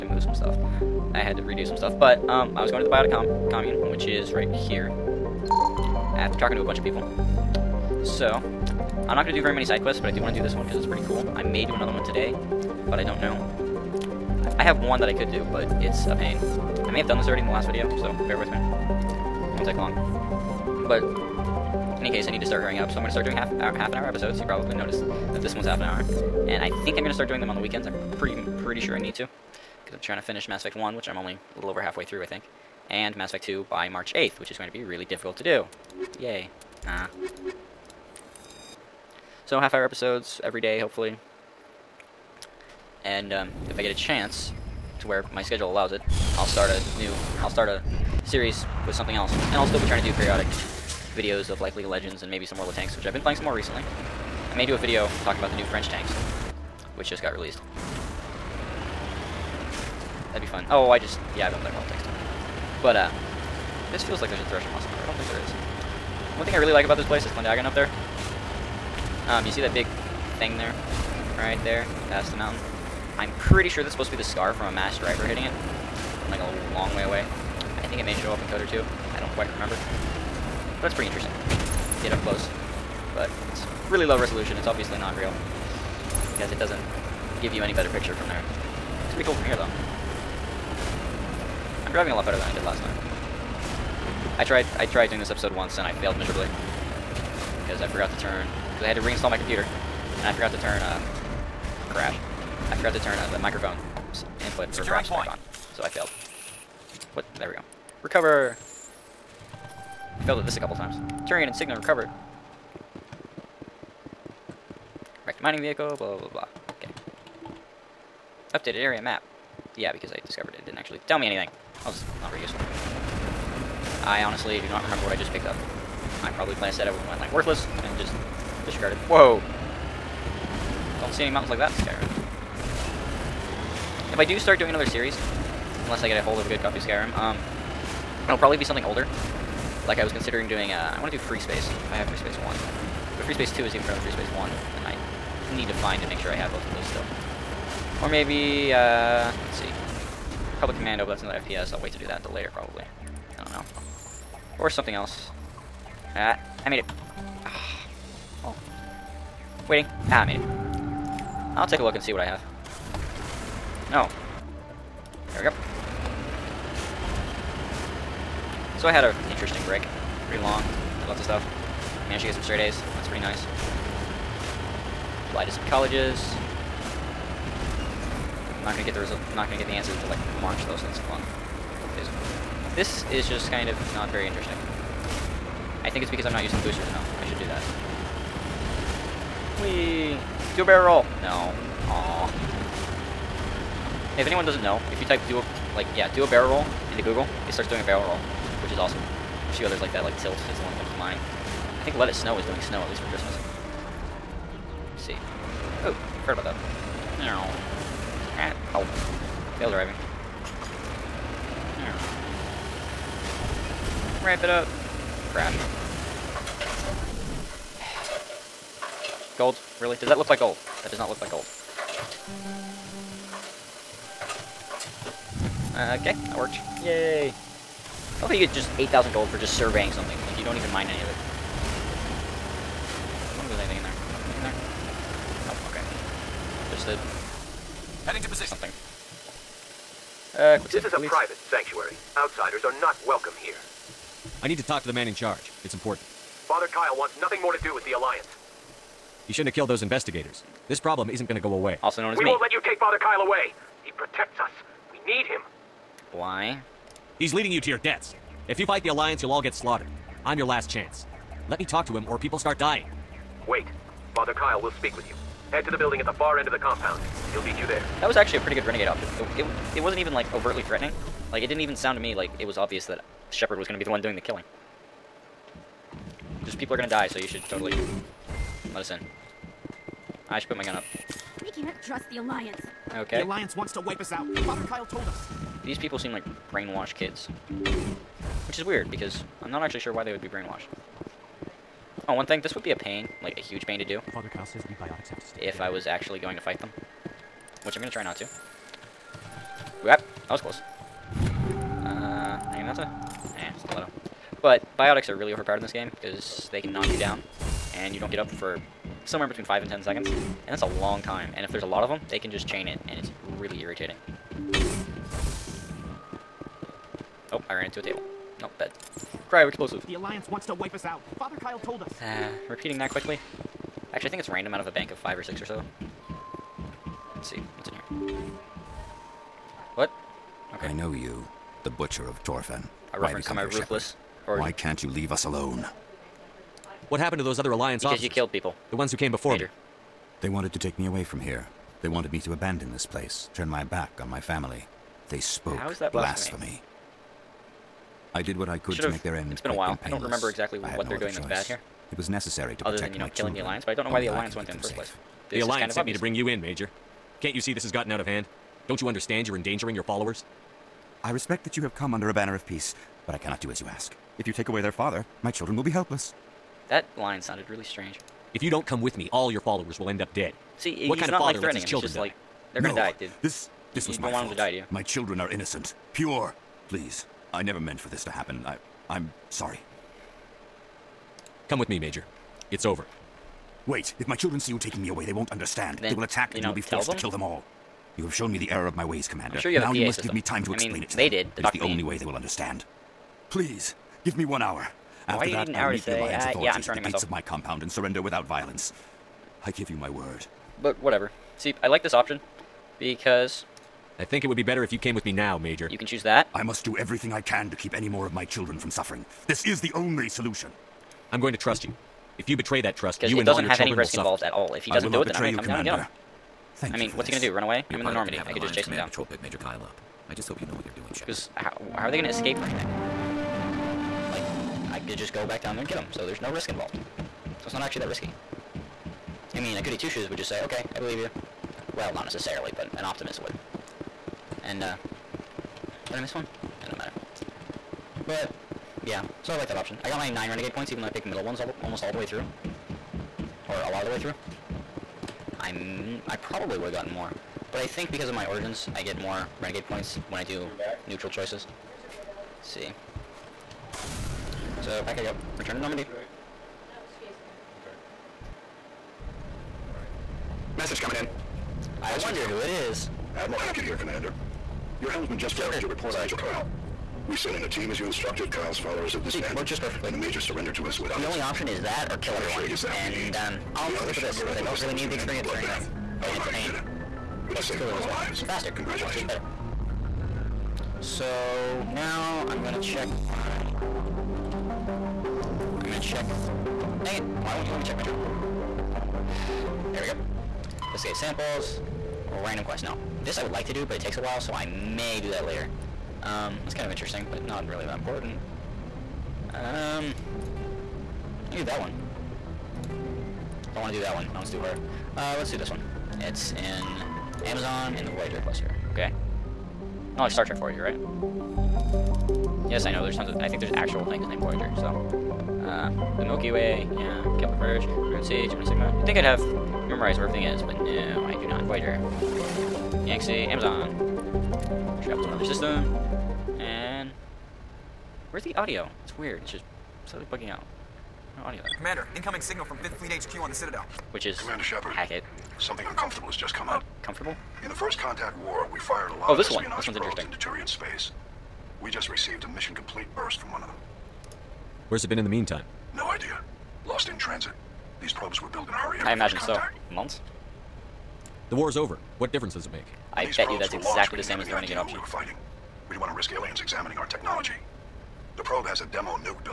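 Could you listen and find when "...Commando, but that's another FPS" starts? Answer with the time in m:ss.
2:30.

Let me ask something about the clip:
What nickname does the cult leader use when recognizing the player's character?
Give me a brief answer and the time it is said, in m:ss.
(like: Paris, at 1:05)
Butcher of Torfan, at 5:31.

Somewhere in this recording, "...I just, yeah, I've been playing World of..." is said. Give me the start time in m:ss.
1:00.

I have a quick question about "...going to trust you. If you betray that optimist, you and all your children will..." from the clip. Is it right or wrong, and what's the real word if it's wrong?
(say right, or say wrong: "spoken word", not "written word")
wrong: "trust", not "optimist".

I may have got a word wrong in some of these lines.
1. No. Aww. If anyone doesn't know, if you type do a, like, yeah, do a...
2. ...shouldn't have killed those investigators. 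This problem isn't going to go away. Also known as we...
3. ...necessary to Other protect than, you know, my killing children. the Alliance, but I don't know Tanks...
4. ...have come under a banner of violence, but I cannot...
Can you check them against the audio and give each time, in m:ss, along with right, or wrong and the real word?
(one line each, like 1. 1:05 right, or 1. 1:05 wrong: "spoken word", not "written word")
1. 3:11 right
2. 4:09 right
3. 5:52 wrong: "Only", not "Tanks"
4. 6:01 wrong: "peace", not "violence".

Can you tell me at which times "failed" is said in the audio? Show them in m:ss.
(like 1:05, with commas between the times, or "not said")
1:36, 1:45, 1:50, 3:29.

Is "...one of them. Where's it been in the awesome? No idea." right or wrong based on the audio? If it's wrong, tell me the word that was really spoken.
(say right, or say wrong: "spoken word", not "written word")
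wrong: "meantime", not "awesome".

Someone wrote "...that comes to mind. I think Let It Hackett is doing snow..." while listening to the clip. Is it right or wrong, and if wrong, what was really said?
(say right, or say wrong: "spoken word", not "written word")
wrong: "Snow", not "Hackett".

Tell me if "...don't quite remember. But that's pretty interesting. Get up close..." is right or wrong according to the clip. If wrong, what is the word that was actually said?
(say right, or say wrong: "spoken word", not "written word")
right.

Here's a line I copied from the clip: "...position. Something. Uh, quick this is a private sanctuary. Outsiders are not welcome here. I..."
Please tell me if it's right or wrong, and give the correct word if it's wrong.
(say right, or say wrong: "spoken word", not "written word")
right.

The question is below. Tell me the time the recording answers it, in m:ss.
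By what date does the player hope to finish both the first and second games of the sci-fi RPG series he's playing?
0:33.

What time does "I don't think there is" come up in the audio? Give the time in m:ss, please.
1:05.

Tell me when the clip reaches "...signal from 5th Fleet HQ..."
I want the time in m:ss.
8:52.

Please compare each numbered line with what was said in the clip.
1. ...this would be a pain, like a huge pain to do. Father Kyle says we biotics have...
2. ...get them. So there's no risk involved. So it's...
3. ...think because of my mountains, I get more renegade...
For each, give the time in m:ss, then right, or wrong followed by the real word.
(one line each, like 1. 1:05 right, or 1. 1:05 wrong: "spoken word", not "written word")
1. 4:52 right
2. 7:05 right
3. 7:27 wrong: "origins", not "mountains".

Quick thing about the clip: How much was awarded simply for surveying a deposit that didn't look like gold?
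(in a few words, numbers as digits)
8,000.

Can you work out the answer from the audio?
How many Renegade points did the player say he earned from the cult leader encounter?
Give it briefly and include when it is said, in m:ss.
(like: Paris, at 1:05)
9, at 7:20.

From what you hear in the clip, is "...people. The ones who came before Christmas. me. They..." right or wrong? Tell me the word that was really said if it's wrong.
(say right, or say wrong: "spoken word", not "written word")
wrong: "Major", not "Christmas".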